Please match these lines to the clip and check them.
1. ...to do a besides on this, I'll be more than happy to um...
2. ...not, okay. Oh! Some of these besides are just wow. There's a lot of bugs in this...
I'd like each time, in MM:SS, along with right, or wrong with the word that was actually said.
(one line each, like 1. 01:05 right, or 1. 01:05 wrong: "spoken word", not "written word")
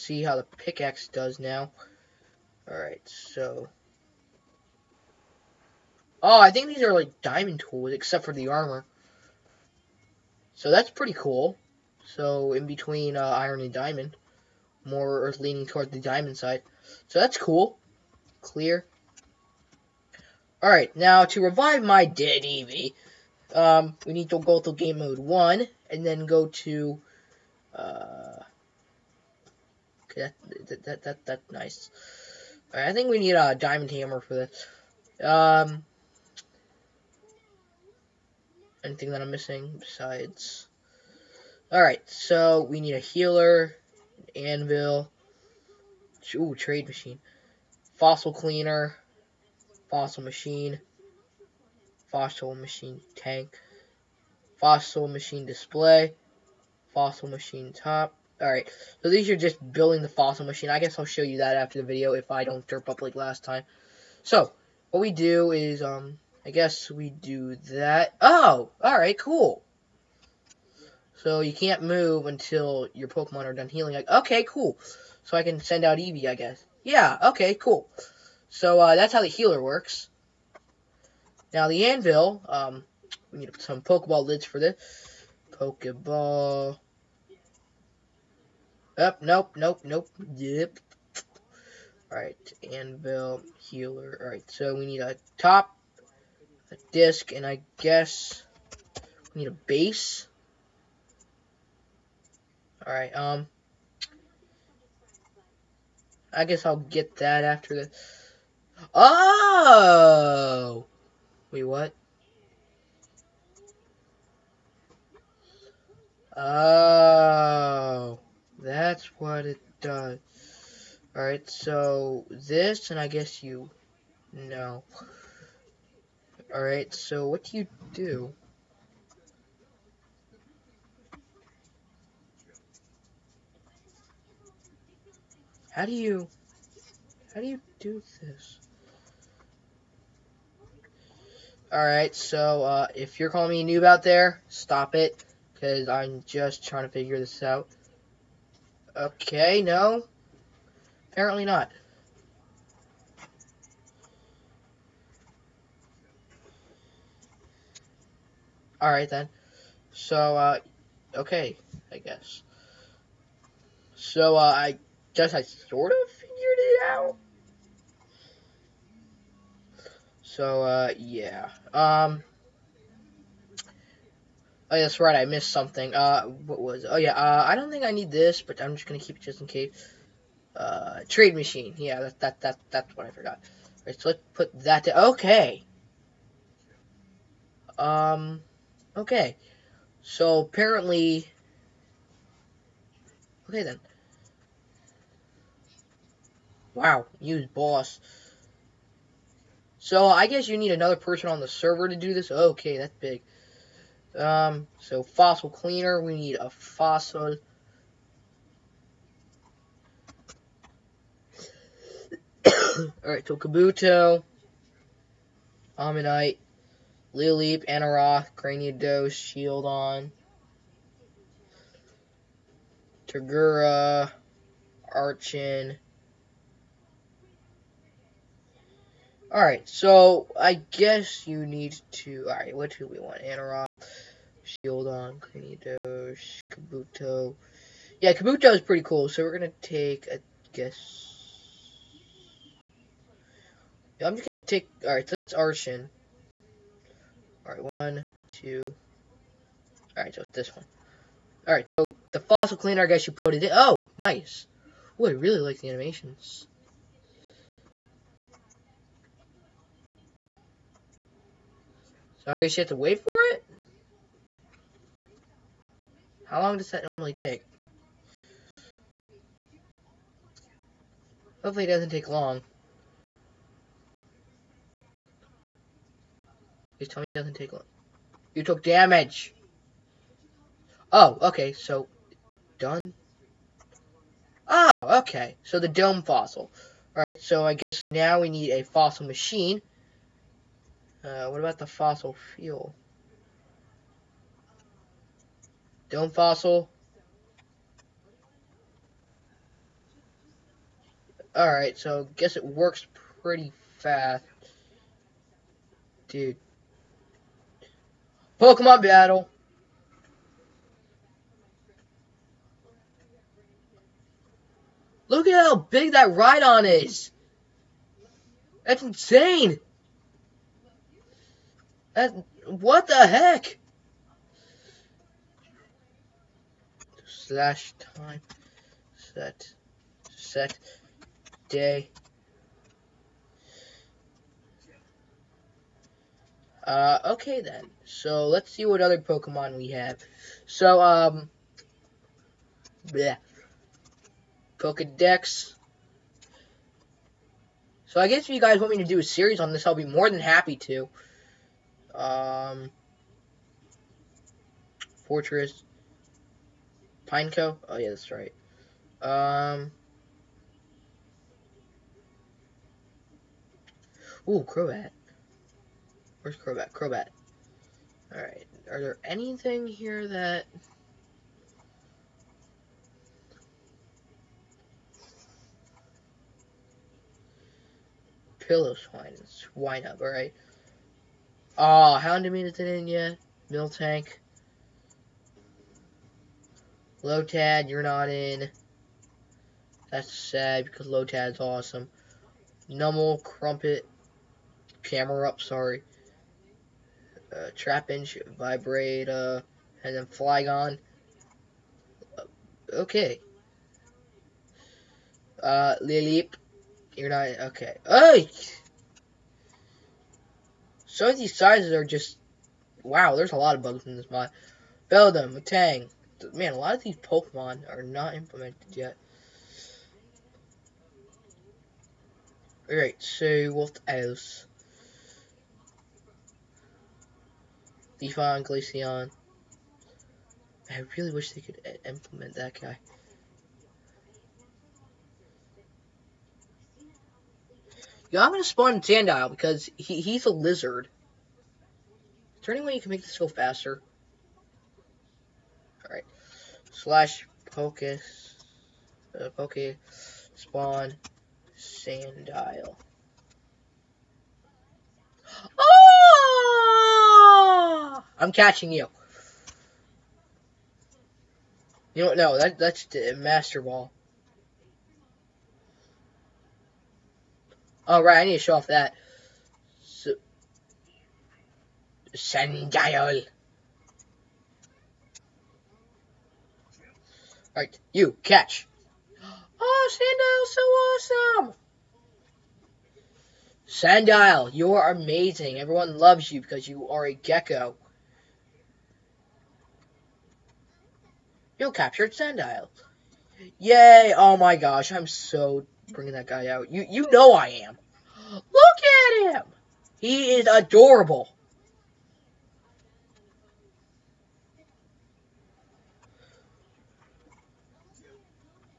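1. 05:48 wrong: "series", not "besides"
2. 06:47 wrong: "sizes", not "besides".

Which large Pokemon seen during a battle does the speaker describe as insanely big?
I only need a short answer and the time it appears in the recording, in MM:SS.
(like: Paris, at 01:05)
Rhydon, at 05:16.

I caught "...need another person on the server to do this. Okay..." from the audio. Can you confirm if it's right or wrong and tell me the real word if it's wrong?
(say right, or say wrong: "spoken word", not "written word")
right.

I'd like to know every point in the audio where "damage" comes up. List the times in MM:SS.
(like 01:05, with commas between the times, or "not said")
04:38.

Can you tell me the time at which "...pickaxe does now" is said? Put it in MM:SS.
00:00.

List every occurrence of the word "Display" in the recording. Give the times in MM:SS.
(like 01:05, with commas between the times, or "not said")
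00:55.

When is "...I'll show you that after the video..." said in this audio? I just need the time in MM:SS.
01:00.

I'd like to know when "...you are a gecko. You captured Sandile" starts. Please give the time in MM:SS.
08:06.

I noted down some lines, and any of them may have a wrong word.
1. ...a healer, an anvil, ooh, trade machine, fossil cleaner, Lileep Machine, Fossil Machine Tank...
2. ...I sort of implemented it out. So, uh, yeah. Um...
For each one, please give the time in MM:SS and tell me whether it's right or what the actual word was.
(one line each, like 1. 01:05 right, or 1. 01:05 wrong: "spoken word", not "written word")
1. 00:42 wrong: "Fossil", not "Lileep"
2. 02:45 wrong: "figured", not "implemented".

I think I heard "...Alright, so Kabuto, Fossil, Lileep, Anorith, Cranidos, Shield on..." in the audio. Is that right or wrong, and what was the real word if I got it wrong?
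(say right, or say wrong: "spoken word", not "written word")
wrong: "Ammonite", not "Fossil".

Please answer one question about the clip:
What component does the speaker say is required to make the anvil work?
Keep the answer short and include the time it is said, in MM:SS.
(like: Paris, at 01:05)
Pokeball lids, at 01:23.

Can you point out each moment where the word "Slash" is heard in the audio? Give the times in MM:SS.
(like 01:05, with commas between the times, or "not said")
05:27, 07:26.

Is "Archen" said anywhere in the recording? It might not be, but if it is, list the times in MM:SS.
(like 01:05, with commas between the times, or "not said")
03:44, 04:05.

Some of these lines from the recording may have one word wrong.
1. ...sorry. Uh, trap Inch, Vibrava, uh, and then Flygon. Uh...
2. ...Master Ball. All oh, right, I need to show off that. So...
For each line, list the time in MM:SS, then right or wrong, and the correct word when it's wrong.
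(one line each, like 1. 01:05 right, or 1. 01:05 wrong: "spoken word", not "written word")
1. 06:35 right
2. 07:43 right.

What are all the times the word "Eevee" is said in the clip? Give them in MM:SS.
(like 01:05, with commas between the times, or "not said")
00:22, 01:15.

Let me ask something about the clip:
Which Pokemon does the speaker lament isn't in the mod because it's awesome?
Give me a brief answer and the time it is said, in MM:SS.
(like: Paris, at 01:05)
Lotad, at 06:30.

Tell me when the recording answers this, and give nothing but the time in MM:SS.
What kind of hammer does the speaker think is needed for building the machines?
00:33.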